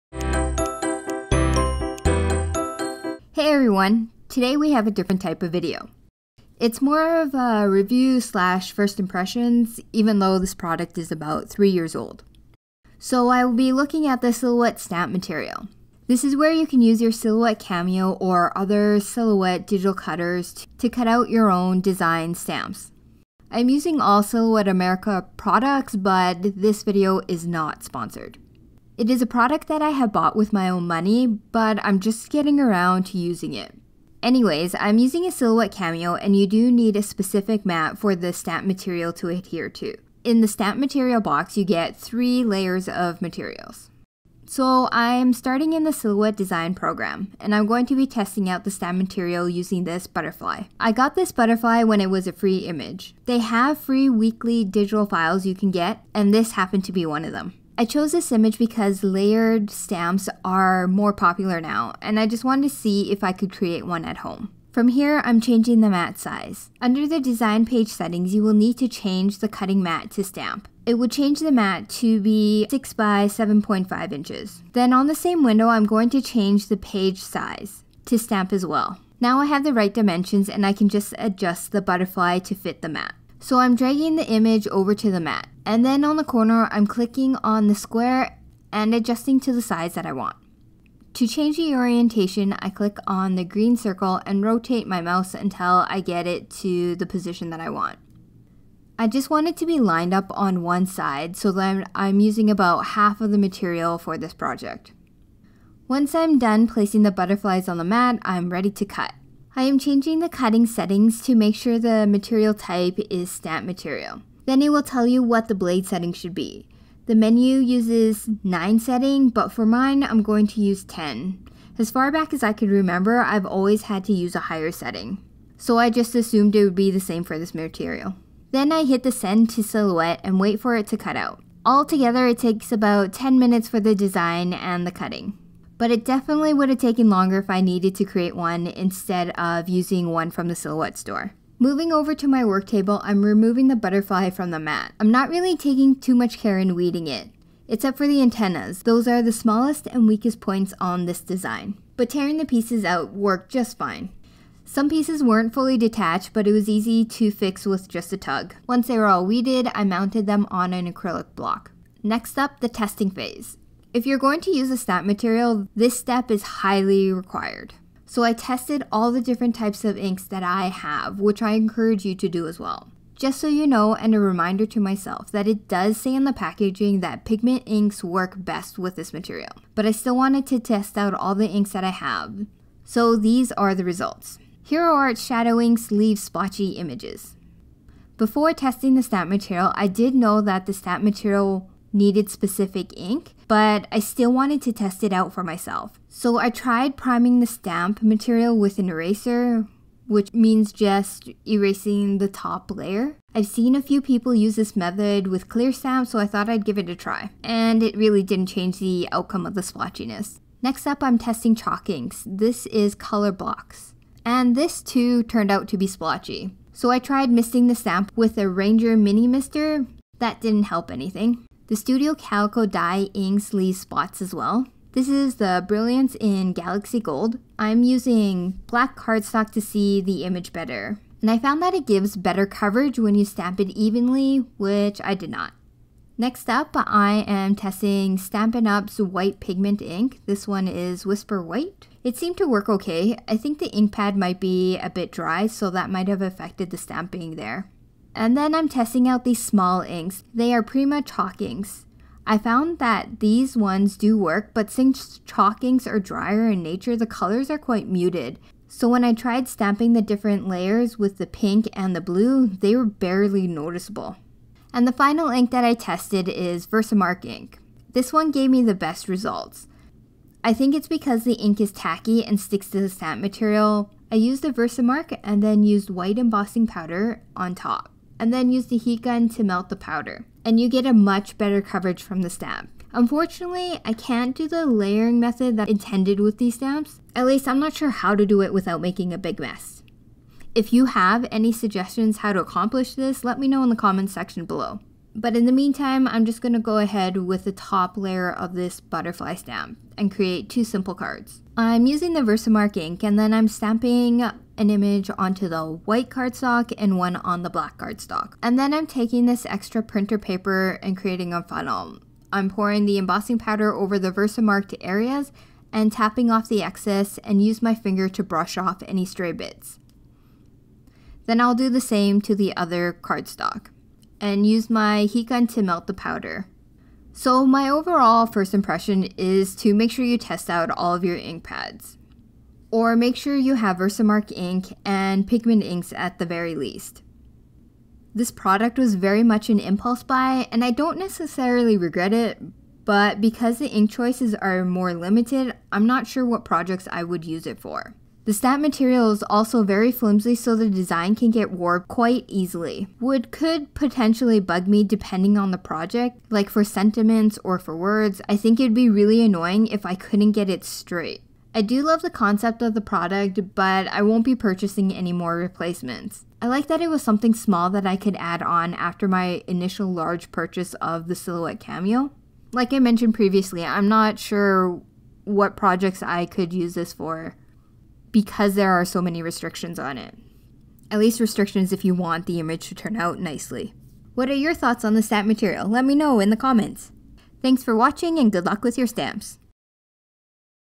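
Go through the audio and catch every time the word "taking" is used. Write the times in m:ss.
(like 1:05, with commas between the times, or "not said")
2:25, 5:08.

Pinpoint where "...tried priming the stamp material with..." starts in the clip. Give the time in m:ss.
3:16.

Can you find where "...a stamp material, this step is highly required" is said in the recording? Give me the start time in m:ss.
2:44.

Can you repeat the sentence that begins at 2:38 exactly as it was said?
Once they were all weeded, I mounted them on an acrylic block.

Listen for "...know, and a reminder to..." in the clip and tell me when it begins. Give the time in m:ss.
2:53.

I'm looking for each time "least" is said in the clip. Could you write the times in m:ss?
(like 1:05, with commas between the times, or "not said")
4:47, 5:36, 6:20.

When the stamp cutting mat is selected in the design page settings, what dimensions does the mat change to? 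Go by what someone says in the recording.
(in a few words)
6 by 7.5 inches.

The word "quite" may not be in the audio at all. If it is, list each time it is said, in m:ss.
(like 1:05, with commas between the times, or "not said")
4:17, 5:51.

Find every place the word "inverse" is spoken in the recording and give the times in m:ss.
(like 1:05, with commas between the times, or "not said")
not said.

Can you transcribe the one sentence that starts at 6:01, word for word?
I do love the concept of the product, but I won't be purchasing any more replacements.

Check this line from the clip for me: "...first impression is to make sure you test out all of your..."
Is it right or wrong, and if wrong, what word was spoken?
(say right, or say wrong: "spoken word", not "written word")
right.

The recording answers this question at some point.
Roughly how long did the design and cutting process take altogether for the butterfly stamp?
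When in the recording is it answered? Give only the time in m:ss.
2:13.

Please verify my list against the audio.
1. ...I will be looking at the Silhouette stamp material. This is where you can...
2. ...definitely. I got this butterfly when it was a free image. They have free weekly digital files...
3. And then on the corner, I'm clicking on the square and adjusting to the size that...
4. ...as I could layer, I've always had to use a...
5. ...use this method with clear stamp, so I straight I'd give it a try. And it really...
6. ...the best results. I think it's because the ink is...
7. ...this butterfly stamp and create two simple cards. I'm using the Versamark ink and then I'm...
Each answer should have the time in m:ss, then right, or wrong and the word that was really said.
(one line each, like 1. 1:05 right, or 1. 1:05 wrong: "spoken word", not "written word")
1. 0:13 right
2. 0:50 wrong: "butterfly", not "definitely"
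3. 1:25 right
4. 2:02 wrong: "remember", not "layer"
5. 3:24 wrong: "thought", not "straight"
6. 4:28 right
7. 4:58 right.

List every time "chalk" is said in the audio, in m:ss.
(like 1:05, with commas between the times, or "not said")
3:31, 4:11, 4:15.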